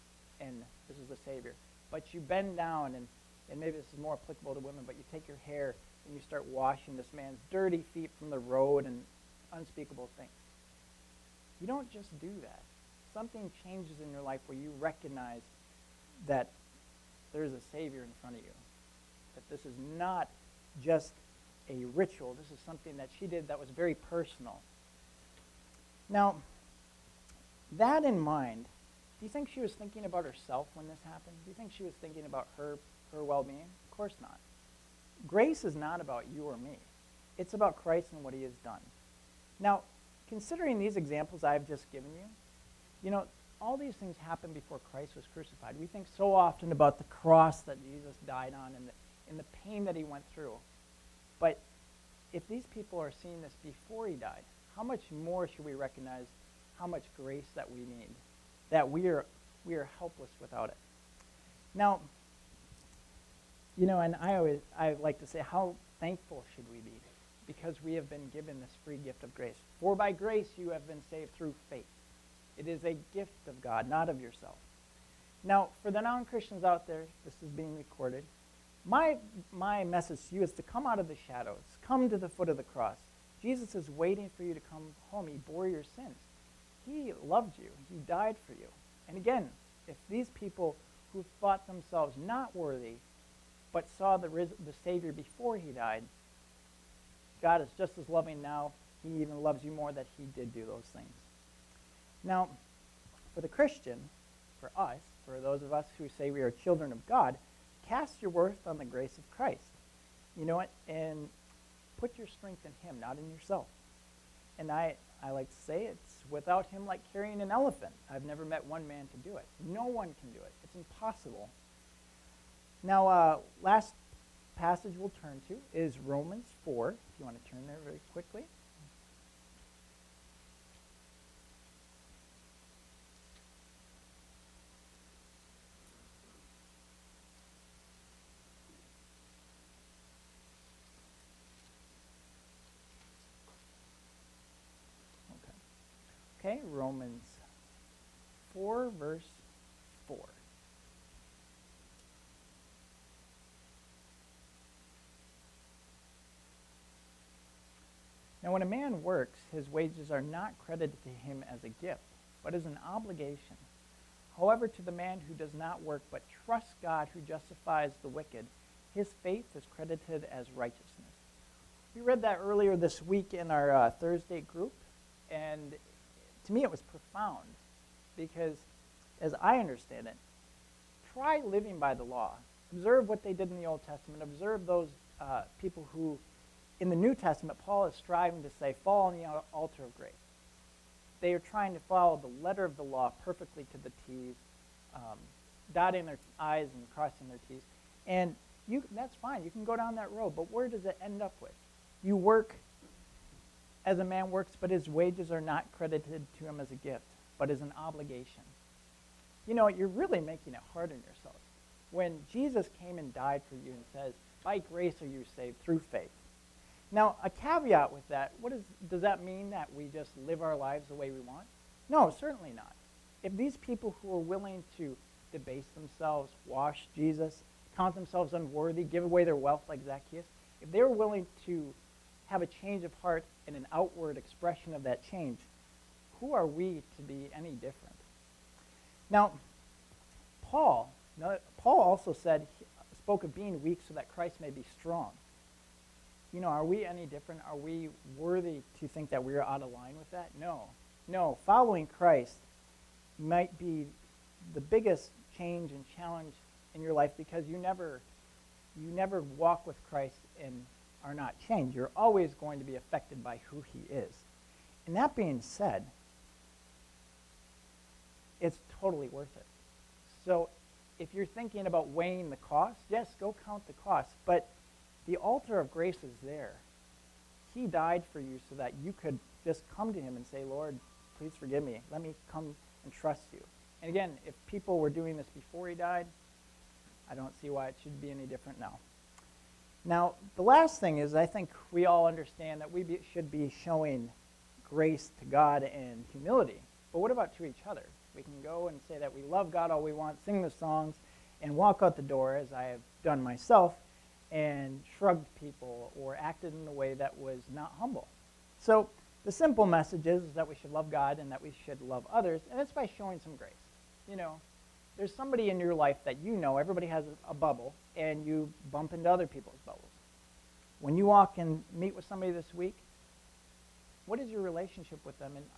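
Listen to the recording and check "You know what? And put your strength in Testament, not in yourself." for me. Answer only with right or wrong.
wrong.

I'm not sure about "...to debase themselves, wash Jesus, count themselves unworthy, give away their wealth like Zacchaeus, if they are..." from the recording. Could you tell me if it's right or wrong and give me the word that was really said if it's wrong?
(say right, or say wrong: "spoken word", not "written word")
right.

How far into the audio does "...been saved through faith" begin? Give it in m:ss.
1:10.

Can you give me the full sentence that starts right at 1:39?
He even loves you more that he did do those things.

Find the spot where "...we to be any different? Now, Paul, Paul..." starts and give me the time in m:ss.
3:56.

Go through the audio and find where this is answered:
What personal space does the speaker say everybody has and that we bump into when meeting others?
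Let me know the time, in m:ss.
5:17.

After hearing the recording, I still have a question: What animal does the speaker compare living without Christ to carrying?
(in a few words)
An elephant.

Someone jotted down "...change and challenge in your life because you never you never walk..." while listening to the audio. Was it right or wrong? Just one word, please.
right.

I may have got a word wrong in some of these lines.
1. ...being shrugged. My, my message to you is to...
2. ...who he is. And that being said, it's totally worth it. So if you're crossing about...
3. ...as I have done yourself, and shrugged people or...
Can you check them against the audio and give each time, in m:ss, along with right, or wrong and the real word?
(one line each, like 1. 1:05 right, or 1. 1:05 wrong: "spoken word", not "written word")
1. 1:17 wrong: "recorded", not "shrugged"
2. 4:23 wrong: "thinking", not "crossing"
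3. 5:02 wrong: "myself", not "yourself".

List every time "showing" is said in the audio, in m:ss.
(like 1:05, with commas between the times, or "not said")
4:53, 5:12.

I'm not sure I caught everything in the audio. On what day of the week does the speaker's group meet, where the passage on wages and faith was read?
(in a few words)
Thursday.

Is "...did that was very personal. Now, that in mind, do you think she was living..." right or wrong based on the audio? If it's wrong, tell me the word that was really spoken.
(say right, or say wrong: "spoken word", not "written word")
wrong: "thinking", not "living".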